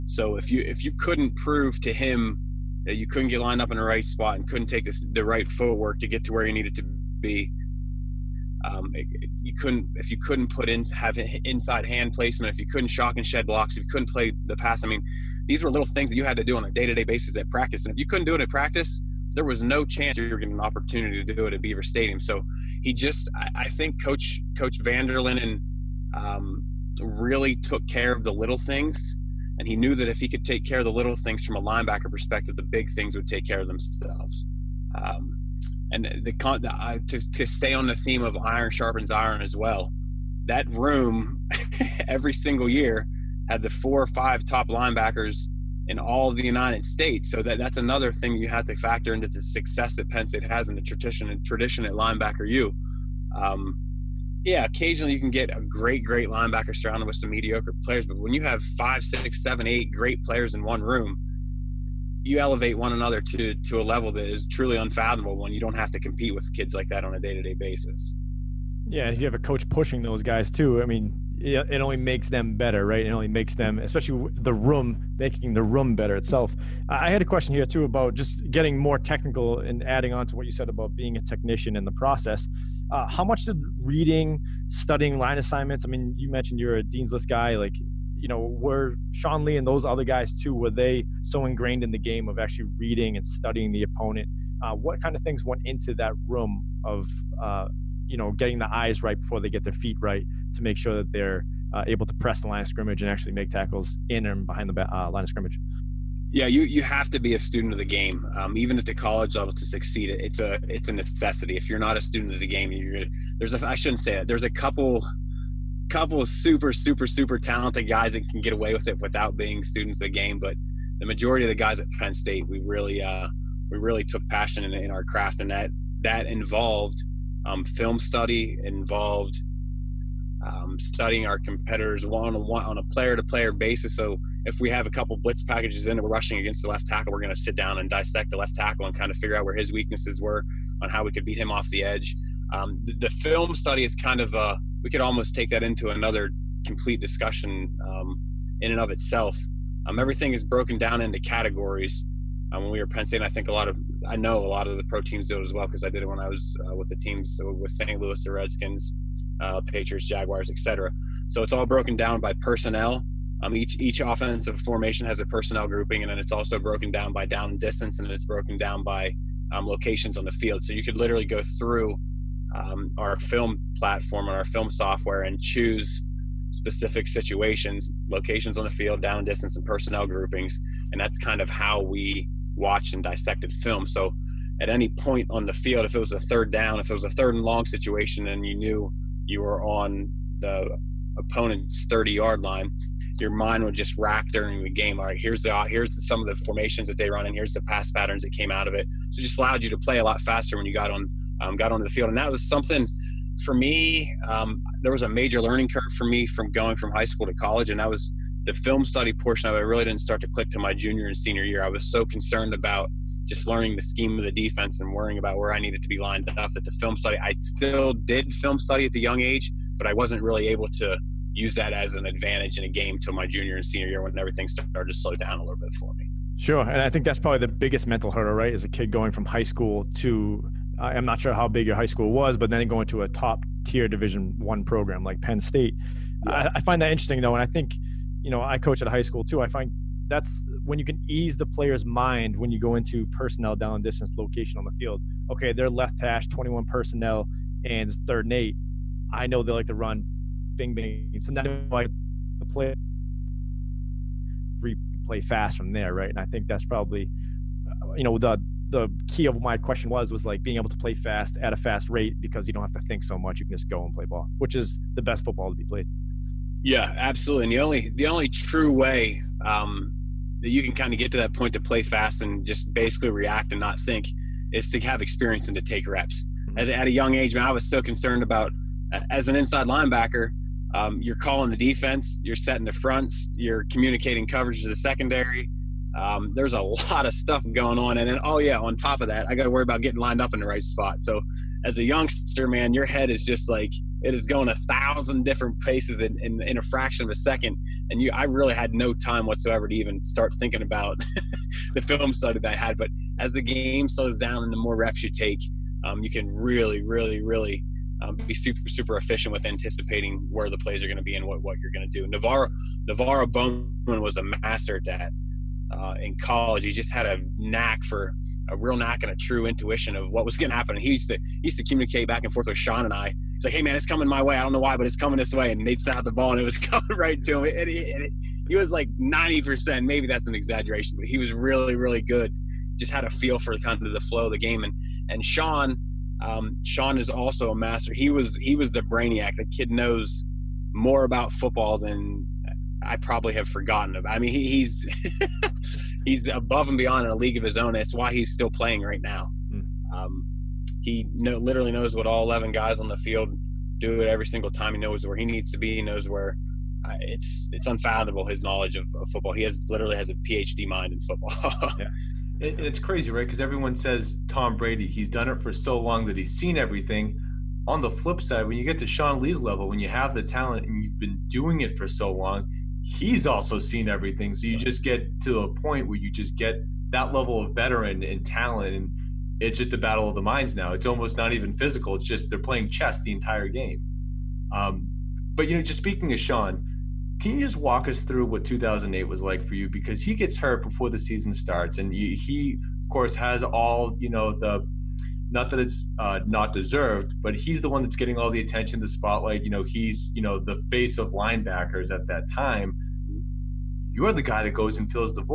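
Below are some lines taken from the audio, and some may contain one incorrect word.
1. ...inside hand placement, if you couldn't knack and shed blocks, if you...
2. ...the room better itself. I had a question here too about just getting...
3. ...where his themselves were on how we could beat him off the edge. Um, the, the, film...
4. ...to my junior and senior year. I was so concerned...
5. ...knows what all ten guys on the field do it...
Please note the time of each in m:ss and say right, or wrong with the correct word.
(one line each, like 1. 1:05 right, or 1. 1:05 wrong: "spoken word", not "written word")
1. 0:11 wrong: "shock", not "knack"
2. 1:15 right
3. 2:19 wrong: "weaknesses", not "themselves"
4. 3:30 right
5. 5:51 wrong: "eleven", not "ten".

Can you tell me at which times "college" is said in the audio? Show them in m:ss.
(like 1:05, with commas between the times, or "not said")
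1:48, 3:27, 5:16.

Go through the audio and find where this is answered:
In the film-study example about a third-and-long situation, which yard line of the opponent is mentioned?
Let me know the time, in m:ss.
3:11.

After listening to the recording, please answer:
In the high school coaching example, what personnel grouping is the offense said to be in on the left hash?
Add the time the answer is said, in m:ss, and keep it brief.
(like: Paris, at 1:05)
21 personnel, at 4:06.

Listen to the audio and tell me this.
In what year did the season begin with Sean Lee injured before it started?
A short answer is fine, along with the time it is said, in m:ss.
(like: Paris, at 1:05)
2008, at 6:28.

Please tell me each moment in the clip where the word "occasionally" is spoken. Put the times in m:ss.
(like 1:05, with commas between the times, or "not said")
0:54.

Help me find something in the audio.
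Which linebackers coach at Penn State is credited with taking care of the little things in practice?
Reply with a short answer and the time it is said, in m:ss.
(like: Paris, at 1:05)
Coach Vanderlinden, at 0:24.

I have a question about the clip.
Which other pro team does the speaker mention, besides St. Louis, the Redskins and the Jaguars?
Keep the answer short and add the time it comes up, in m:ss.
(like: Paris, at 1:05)
Patriots, at 2:39.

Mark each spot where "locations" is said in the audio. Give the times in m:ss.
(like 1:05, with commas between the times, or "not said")
2:49, 2:58, 4:04.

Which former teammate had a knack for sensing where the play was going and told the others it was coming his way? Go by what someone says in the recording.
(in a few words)
Navarro Bowman.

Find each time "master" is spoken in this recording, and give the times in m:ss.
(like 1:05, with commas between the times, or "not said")
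5:14, 5:37.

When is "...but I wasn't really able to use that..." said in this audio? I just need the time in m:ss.
3:39.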